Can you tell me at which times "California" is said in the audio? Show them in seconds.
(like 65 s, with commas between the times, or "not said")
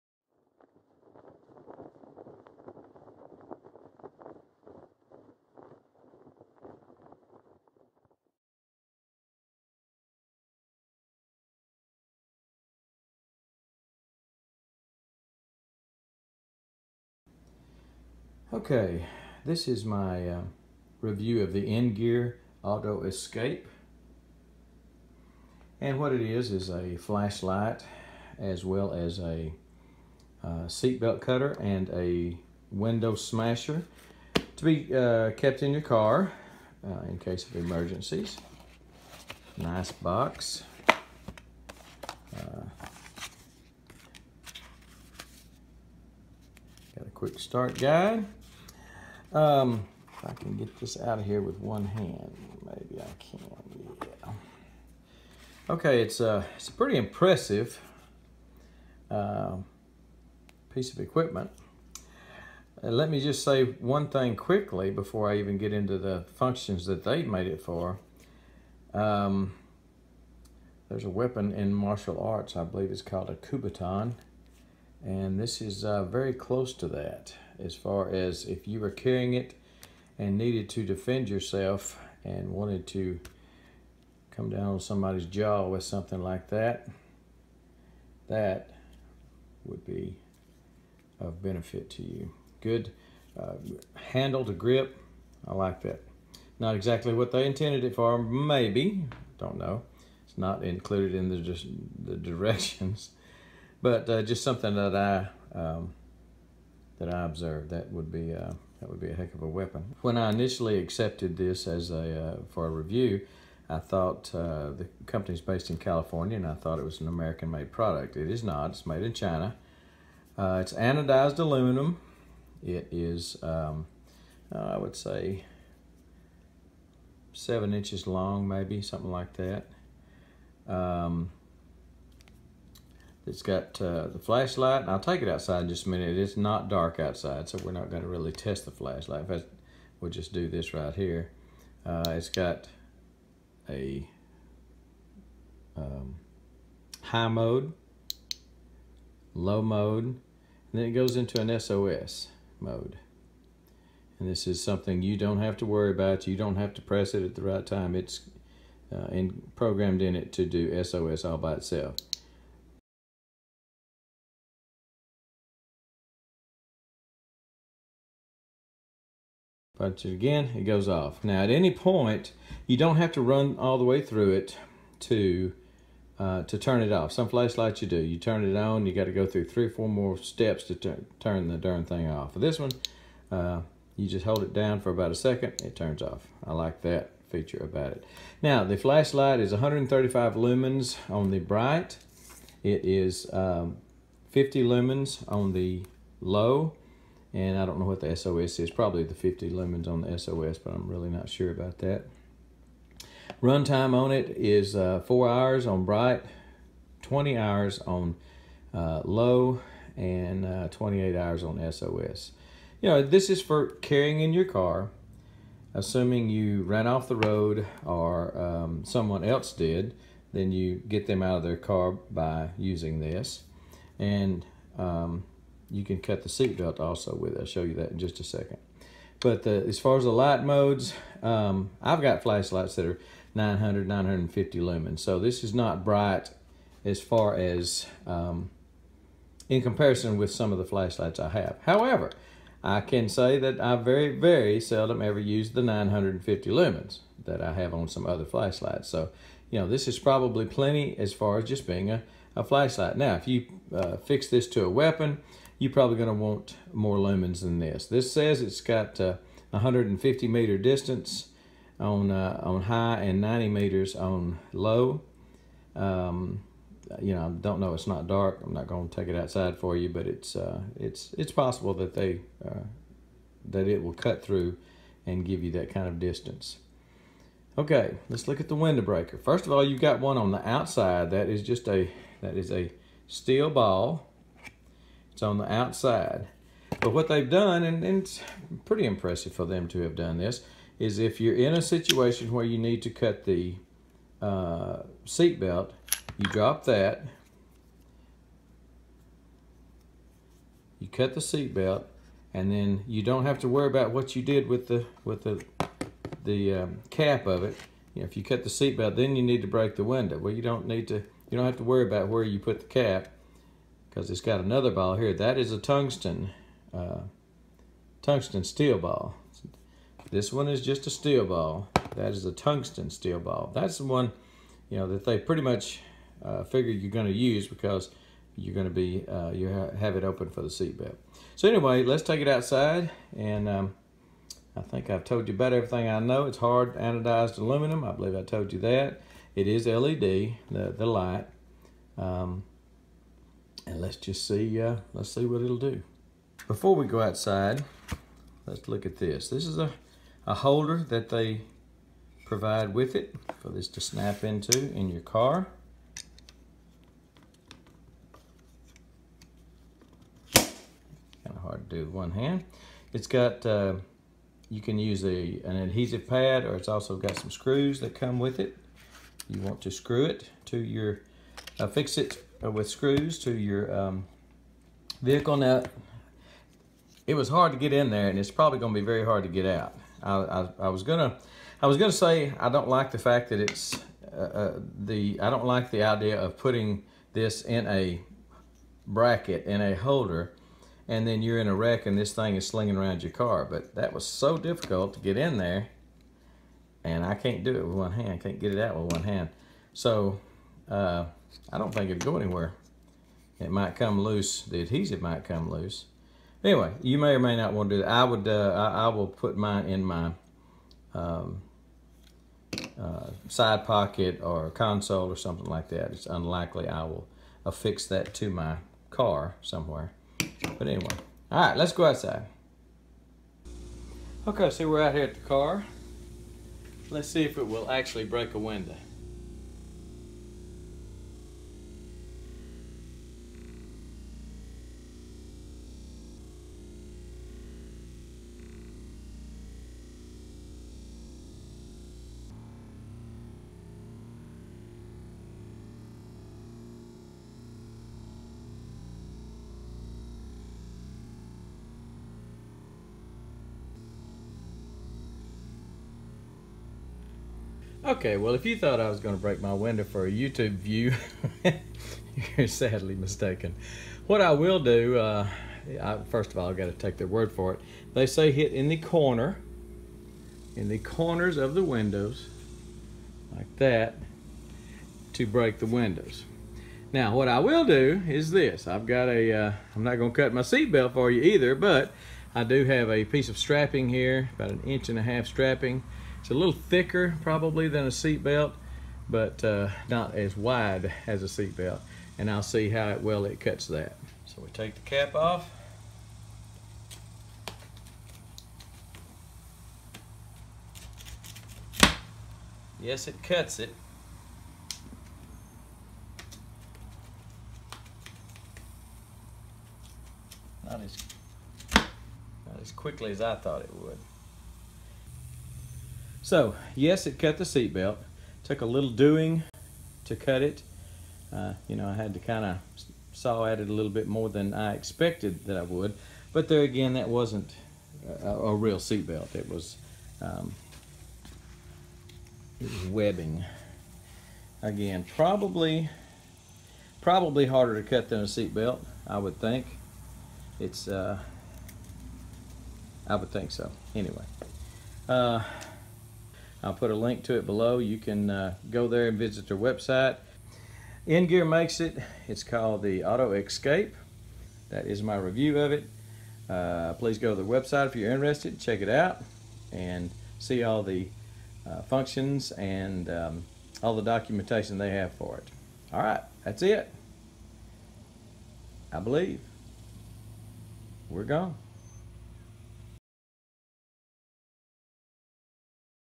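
115 s.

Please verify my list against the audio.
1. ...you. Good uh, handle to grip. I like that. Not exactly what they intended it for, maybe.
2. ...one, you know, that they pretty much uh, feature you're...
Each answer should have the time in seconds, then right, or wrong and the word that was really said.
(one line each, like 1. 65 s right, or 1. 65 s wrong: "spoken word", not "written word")
1. 92 s right
2. 323 s wrong: "figure", not "feature".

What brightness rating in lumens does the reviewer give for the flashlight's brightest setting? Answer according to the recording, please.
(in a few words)
135 lumens.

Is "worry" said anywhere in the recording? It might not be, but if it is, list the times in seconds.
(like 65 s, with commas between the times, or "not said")
155 s, 303 s, 311 s.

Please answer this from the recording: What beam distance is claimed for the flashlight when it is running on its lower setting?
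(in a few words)
90 meters.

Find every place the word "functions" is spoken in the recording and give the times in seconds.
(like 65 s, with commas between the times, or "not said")
66 s, 561 s.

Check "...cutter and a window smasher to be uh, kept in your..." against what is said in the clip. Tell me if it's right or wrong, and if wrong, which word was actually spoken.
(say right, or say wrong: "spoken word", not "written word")
right.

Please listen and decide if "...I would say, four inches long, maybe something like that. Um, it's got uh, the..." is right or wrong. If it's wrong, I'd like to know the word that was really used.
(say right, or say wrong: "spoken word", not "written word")
wrong: "seven", not "four".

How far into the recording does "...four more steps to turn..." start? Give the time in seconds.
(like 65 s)
179 s.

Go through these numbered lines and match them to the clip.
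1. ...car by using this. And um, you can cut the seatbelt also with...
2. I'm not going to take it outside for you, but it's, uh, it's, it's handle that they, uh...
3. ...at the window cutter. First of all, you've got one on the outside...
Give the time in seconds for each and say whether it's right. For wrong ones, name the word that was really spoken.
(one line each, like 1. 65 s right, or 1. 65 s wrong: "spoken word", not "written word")
1. 221 s right
2. 268 s wrong: "possible", not "handle"
3. 278 s wrong: "breaker", not "cutter".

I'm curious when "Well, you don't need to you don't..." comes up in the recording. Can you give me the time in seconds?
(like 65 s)
310 s.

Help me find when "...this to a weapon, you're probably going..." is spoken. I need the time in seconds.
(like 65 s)
254 s.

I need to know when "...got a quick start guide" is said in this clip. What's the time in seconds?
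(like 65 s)
46 s.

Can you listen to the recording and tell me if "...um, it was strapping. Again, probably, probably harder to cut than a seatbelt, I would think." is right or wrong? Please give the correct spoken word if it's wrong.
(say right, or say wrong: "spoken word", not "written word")
wrong: "webbing", not "strapping".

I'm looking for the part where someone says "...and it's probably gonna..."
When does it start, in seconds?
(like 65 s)
378 s.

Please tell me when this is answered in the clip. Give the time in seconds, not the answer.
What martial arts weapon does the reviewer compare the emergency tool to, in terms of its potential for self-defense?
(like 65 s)
73 s.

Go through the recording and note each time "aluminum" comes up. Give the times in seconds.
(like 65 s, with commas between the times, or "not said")
121 s, 337 s.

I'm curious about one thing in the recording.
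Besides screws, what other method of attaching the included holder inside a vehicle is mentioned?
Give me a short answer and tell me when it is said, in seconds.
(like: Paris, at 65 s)
adhesive pad, at 365 s.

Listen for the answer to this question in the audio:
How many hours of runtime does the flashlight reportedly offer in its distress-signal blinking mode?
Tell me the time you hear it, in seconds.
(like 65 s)
210 s.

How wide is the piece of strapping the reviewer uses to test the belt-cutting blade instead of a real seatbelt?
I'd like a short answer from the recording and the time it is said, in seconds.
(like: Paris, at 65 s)
1.5 inches, at 484 s.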